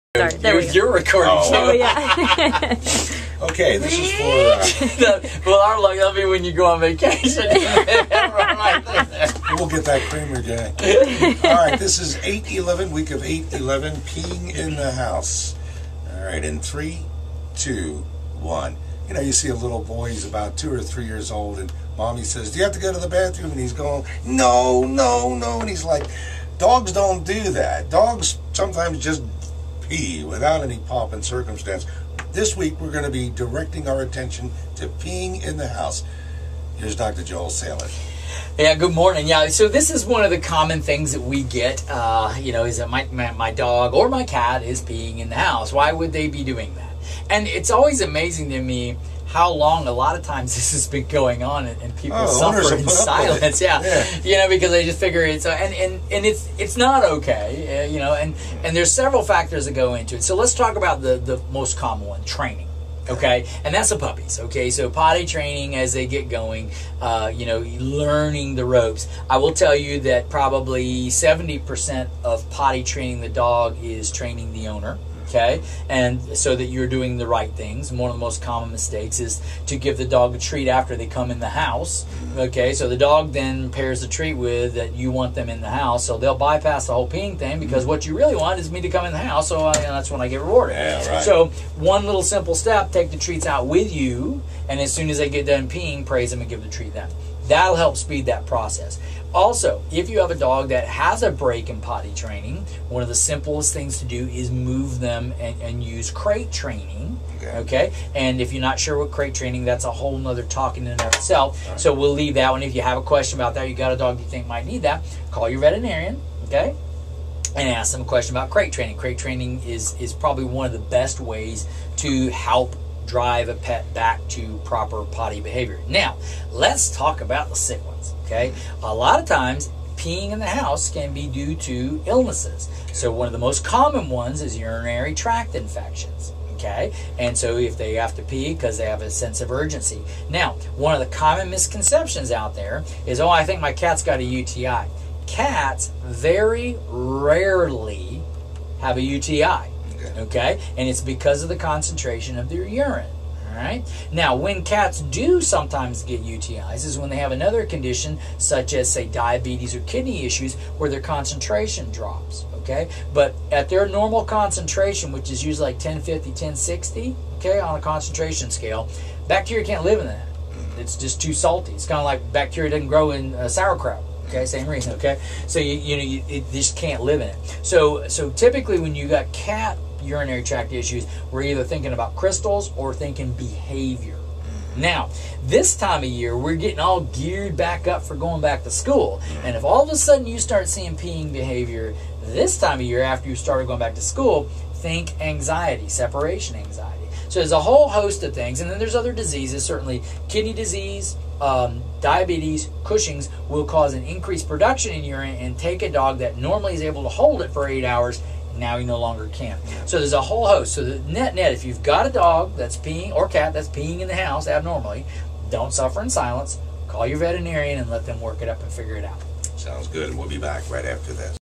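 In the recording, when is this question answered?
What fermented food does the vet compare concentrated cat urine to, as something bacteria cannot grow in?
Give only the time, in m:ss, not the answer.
2:53.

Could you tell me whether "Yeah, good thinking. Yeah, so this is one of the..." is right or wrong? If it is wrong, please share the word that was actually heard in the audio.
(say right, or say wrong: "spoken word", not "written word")
wrong: "morning", not "thinking".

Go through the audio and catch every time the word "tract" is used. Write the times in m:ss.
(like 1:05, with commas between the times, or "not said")
2:15, 3:00.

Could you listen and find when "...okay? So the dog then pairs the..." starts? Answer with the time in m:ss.
1:22.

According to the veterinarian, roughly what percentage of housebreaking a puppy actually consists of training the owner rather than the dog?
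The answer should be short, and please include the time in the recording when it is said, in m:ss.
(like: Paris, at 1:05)
70%, at 1:11.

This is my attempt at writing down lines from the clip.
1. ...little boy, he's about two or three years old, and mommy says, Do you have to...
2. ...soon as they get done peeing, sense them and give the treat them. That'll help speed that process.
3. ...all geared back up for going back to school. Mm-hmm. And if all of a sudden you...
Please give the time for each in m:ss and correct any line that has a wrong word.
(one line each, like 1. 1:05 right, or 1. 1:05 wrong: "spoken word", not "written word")
1. 0:19 right
2. 1:34 wrong: "praise", not "sense"
3. 3:06 right.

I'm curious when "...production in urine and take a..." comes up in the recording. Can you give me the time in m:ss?
3:24.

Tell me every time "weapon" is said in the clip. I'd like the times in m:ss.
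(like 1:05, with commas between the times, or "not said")
not said.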